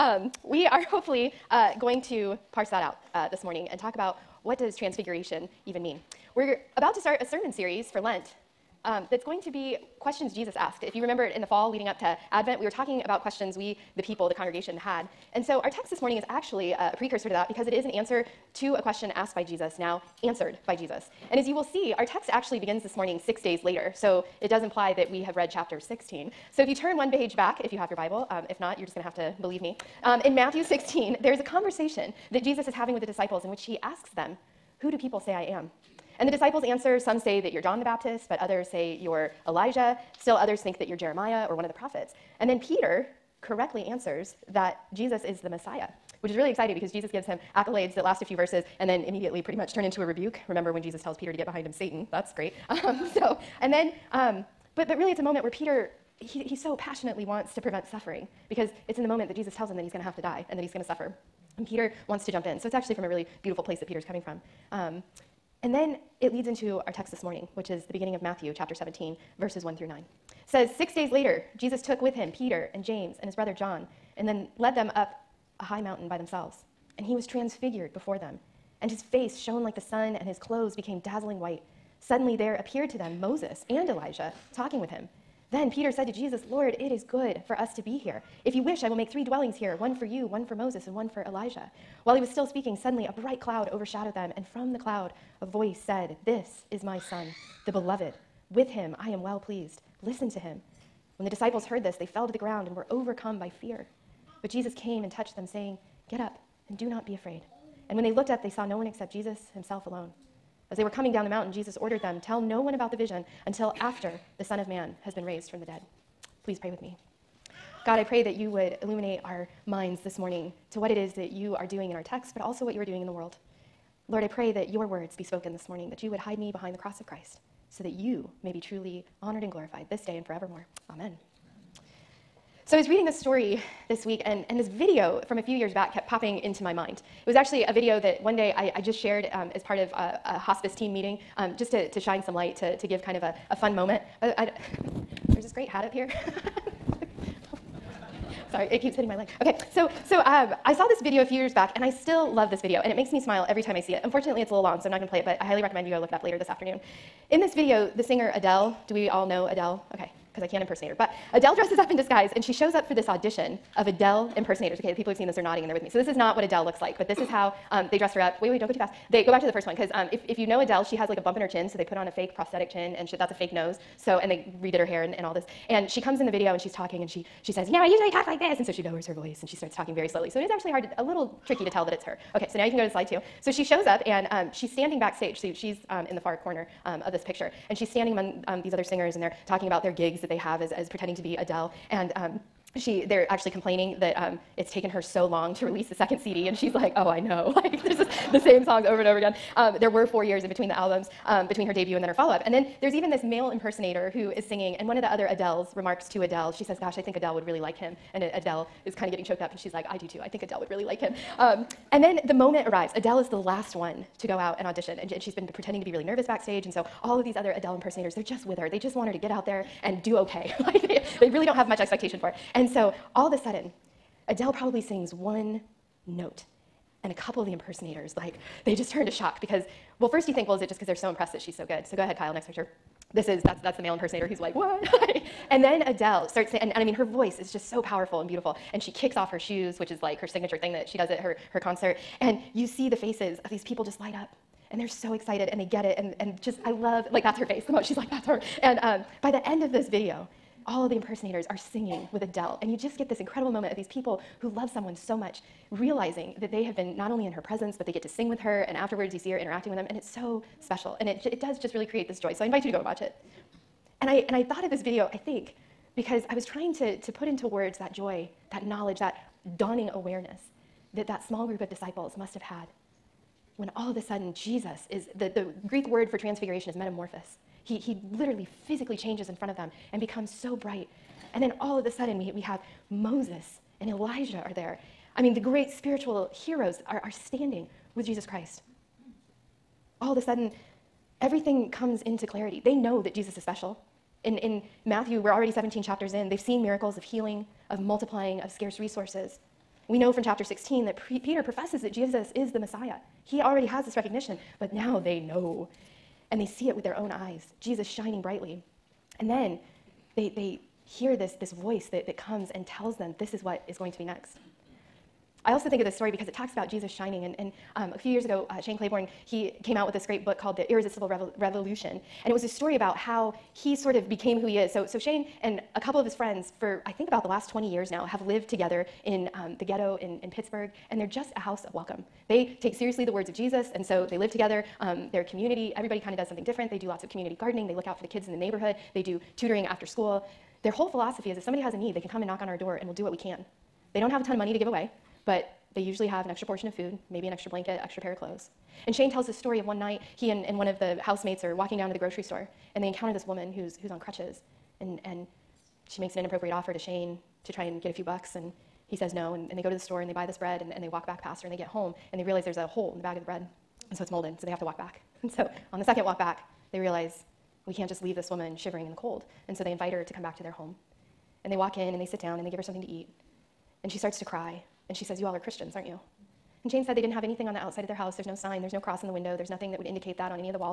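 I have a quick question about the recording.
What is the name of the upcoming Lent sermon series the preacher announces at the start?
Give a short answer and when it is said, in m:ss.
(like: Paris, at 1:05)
Questions Jesus asked, at 0:10.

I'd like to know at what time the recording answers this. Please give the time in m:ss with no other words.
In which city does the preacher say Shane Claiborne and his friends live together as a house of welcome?
5:30.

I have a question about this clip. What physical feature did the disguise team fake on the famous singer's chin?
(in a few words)
A bump.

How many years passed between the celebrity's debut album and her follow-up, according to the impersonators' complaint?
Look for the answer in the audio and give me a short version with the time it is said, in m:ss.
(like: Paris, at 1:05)
4, at 3:20.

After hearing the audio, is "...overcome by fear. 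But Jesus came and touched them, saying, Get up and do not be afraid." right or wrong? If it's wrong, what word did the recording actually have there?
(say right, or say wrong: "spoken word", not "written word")
right.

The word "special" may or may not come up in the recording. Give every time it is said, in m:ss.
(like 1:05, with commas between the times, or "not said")
4:20, 4:53.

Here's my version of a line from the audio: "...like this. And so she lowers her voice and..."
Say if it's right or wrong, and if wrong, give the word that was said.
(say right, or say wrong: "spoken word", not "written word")
right.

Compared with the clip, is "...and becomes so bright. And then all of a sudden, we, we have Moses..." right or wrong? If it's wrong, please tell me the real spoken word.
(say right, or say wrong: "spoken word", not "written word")
right.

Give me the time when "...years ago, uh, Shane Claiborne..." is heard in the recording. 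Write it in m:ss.
5:18.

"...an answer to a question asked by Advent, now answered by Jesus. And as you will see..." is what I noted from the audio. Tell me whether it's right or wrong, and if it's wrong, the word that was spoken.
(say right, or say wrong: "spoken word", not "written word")
wrong: "Jesus", not "Advent".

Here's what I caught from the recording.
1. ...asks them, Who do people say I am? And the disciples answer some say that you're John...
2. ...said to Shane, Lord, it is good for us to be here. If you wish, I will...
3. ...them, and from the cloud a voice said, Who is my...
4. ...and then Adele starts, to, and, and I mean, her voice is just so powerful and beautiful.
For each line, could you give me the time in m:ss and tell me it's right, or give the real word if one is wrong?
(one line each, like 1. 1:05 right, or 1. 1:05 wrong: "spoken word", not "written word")
1. 0:33 right
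2. 1:25 wrong: "Jesus", not "Shane"
3. 1:34 wrong: "This", not "Who"
4. 3:55 right.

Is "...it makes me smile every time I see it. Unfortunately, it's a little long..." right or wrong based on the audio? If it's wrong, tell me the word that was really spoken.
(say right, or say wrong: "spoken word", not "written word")
right.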